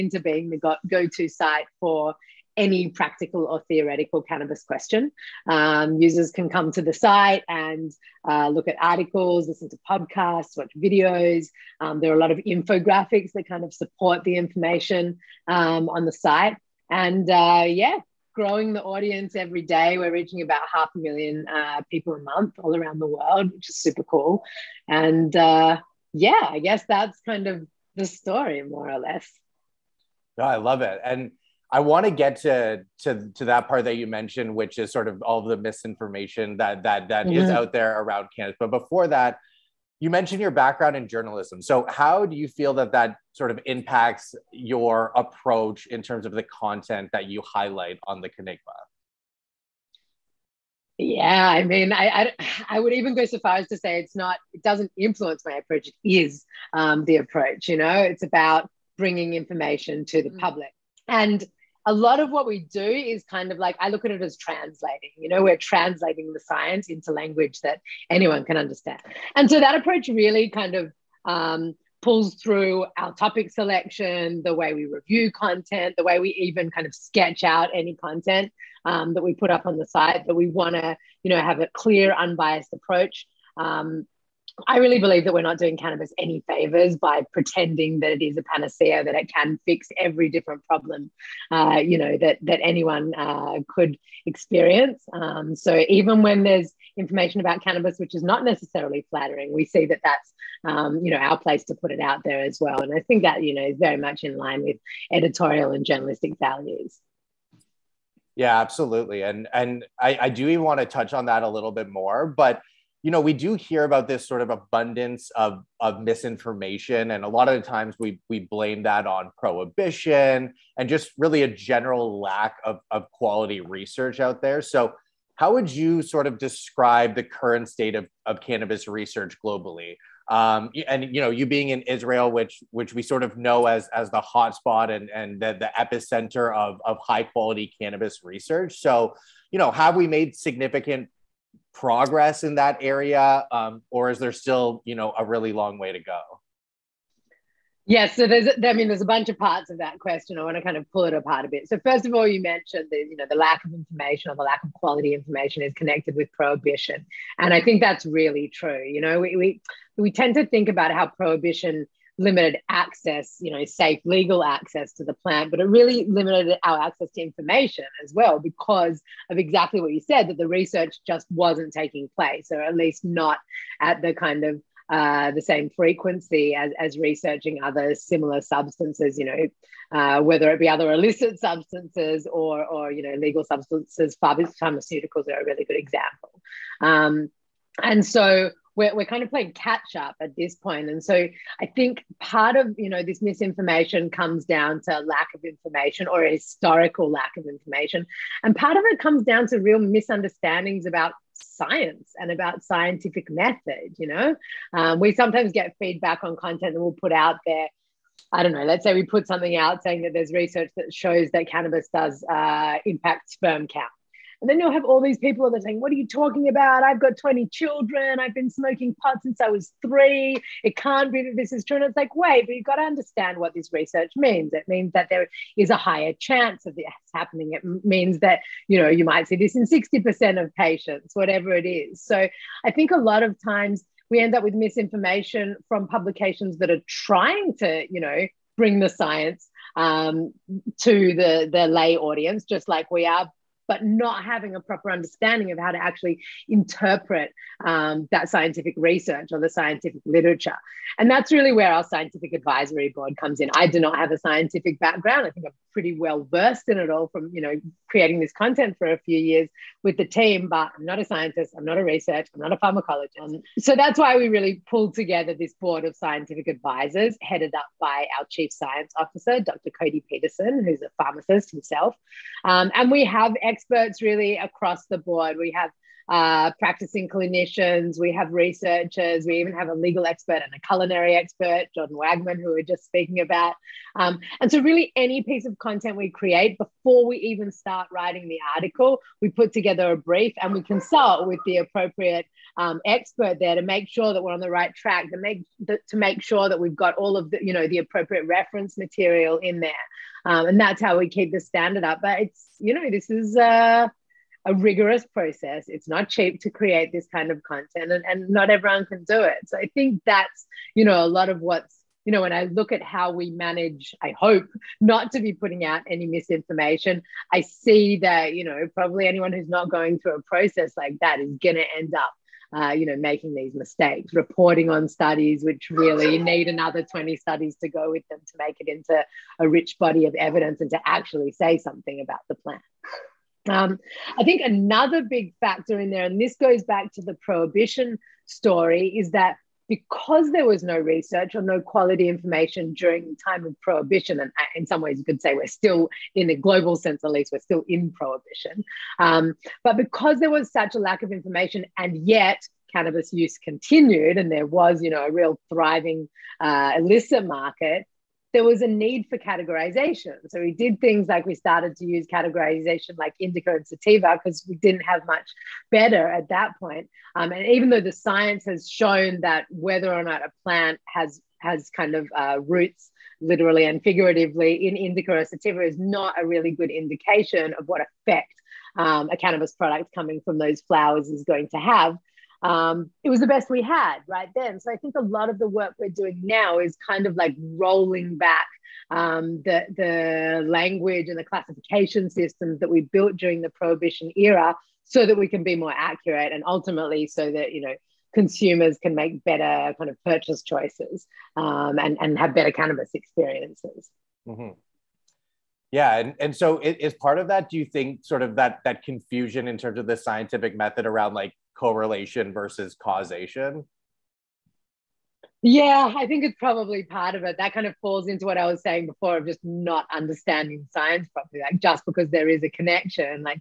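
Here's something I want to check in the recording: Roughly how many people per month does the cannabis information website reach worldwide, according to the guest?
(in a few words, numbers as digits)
half a million.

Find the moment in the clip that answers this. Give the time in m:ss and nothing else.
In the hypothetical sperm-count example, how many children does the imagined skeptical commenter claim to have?
3:37.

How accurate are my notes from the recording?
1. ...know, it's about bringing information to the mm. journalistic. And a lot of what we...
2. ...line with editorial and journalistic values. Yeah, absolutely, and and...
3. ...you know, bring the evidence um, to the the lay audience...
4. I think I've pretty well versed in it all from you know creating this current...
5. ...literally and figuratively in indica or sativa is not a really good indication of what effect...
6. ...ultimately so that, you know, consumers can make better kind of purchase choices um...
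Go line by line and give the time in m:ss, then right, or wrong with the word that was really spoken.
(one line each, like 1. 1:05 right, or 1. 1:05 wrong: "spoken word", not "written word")
1. 0:57 wrong: "public", not "journalistic"
2. 1:44 right
3. 3:57 wrong: "science", not "evidence"
4. 4:15 wrong: "content", not "current"
5. 6:13 right
6. 6:36 right.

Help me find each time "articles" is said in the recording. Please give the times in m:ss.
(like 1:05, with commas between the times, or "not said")
0:08, 4:48.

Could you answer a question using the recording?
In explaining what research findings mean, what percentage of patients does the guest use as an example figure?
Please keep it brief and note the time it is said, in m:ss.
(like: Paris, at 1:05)
60%, at 3:49.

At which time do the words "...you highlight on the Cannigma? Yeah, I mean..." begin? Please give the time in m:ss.
0:47.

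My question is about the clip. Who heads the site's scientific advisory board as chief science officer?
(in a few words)
Dr Cody Peterson.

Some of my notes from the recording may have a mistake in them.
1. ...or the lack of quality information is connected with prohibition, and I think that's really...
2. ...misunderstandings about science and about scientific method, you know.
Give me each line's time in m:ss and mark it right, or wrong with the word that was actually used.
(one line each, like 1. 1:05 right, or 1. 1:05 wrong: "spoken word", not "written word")
1. 2:34 right
2. 3:19 right.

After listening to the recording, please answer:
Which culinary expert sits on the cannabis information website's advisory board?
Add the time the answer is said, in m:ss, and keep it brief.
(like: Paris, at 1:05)
Jordan Wagman, at 4:41.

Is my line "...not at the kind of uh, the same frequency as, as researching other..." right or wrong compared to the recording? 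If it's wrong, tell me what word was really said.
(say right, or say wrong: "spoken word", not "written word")
right.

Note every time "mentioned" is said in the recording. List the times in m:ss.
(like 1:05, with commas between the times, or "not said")
0:34, 0:40, 2:32.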